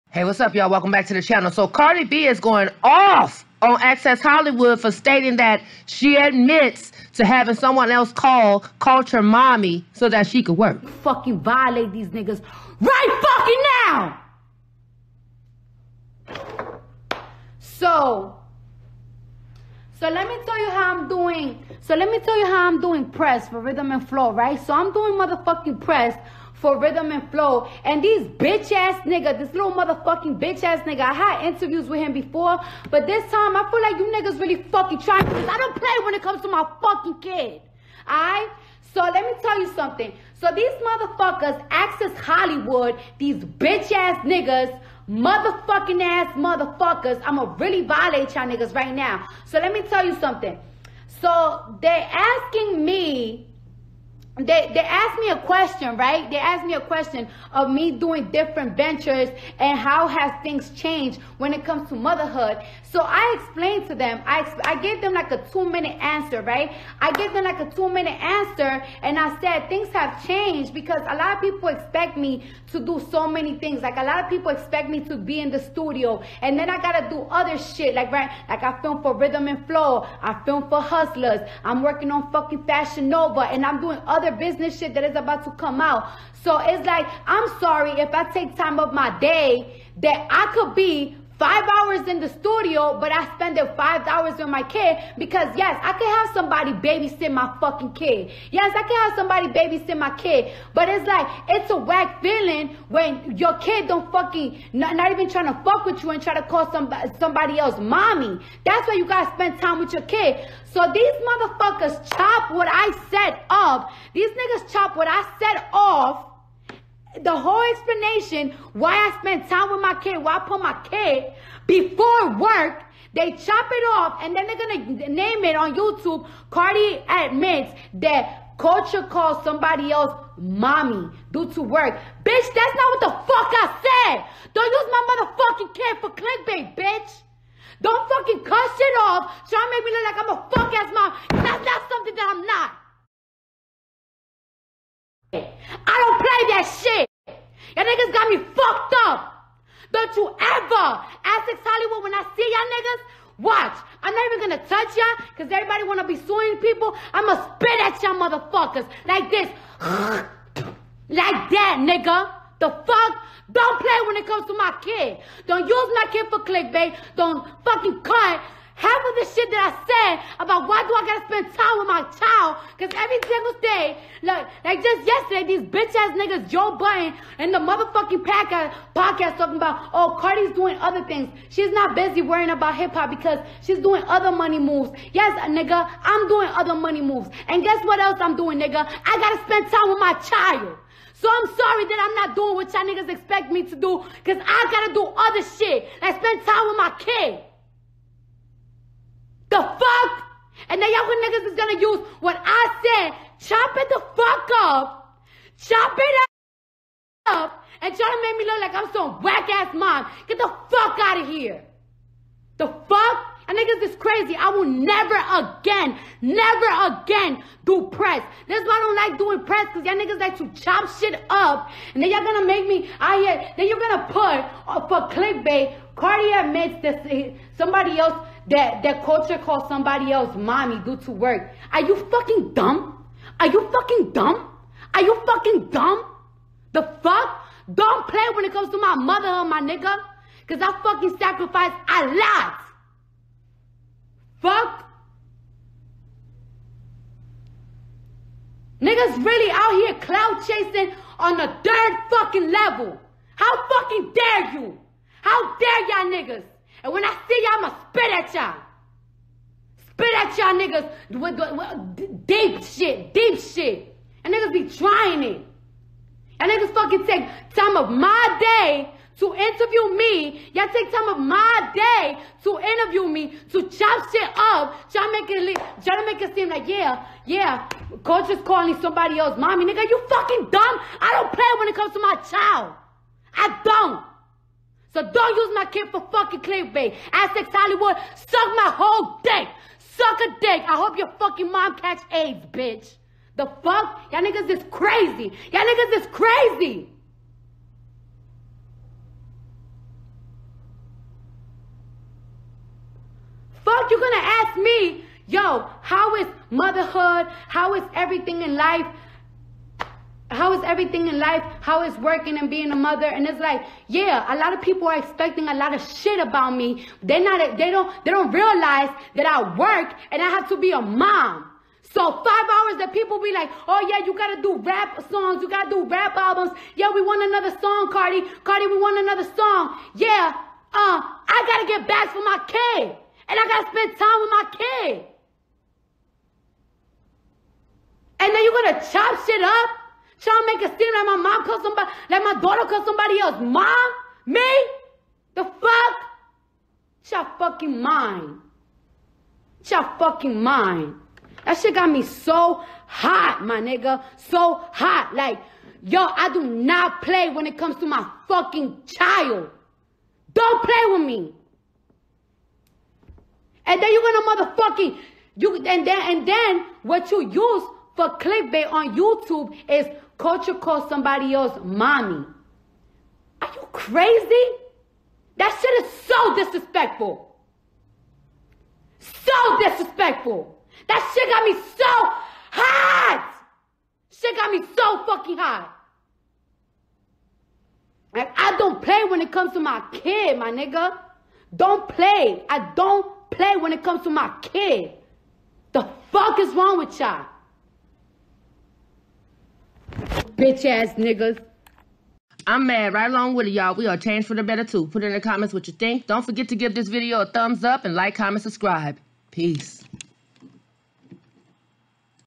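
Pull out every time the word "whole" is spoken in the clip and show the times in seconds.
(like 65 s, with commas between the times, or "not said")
117 s, 288 s.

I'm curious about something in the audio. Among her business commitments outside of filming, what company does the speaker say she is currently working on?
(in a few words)
Fashion Nova.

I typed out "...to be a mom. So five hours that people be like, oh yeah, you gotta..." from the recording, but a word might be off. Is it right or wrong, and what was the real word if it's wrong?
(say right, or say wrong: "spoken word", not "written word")
right.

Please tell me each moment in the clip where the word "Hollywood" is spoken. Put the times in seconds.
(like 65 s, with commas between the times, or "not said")
4 s, 42 s, 151 s, 287 s.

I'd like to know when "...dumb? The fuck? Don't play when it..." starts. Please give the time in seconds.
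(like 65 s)
235 s.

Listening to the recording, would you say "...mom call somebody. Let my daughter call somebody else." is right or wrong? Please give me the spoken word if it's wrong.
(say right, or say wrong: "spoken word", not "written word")
right.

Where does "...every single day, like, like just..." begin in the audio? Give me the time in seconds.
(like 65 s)
172 s.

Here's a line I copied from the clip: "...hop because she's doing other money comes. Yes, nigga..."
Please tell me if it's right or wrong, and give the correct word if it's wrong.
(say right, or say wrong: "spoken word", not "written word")
wrong: "moves", not "comes".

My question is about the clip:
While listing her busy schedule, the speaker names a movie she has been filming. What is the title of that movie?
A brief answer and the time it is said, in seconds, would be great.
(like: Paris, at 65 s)
Hustlers, at 80 s.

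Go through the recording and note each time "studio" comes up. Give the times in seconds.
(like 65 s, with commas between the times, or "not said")
75 s, 92 s.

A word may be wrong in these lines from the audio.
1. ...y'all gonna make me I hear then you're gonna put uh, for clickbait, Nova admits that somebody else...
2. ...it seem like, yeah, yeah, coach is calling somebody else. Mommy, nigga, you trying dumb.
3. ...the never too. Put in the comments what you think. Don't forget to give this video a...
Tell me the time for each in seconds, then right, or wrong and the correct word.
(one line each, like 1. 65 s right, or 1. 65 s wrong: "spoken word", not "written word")
1. 222 s wrong: "Cardi", not "Nova"
2. 276 s wrong: "fucking", not "trying"
3. 404 s wrong: "better", not "never".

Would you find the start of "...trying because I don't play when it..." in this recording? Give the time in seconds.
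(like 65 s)
34 s.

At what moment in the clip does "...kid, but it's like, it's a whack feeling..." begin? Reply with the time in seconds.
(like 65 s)
100 s.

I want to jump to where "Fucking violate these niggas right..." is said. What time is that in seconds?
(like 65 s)
10 s.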